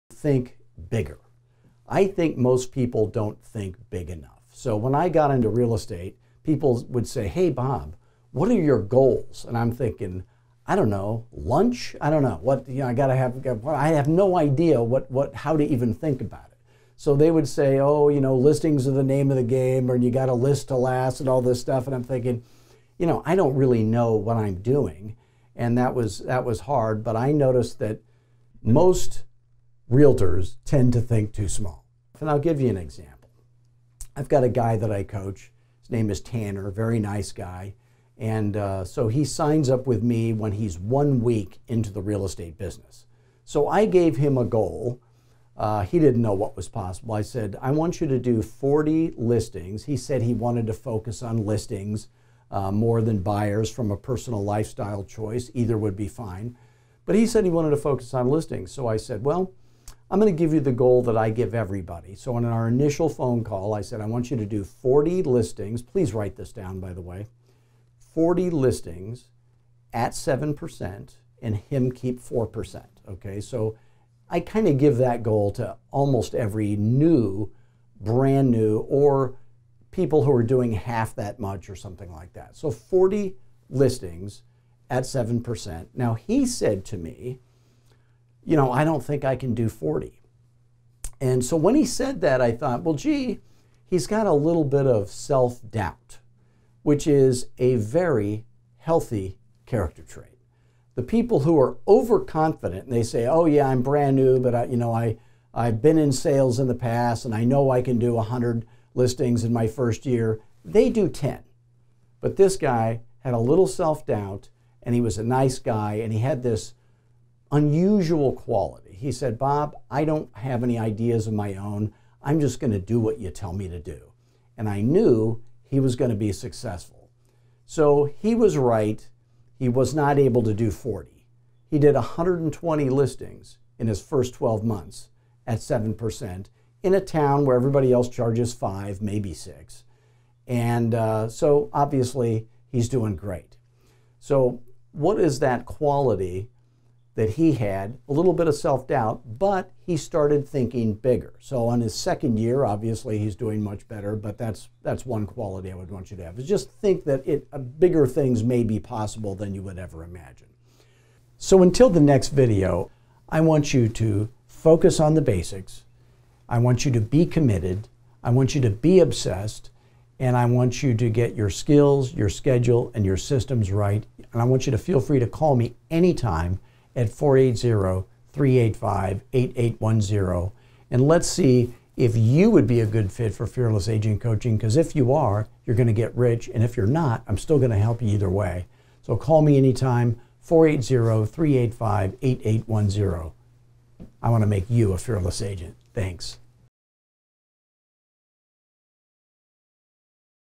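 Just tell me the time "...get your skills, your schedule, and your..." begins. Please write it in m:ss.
2:51.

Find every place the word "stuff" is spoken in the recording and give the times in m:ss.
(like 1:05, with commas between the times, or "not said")
0:21.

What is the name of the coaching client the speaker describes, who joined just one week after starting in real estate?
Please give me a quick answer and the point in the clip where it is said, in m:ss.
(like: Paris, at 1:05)
Tanner, at 0:36.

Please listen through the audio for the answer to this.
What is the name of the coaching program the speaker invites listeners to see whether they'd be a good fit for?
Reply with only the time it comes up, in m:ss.
3:03.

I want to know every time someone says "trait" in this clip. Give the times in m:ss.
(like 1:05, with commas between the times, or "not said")
1:40.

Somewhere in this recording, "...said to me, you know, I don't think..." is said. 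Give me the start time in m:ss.
1:26.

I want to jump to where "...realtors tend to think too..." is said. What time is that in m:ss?
0:29.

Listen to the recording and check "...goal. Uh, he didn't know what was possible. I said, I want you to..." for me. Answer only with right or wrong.
right.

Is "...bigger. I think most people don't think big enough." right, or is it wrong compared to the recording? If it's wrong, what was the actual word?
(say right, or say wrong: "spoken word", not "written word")
right.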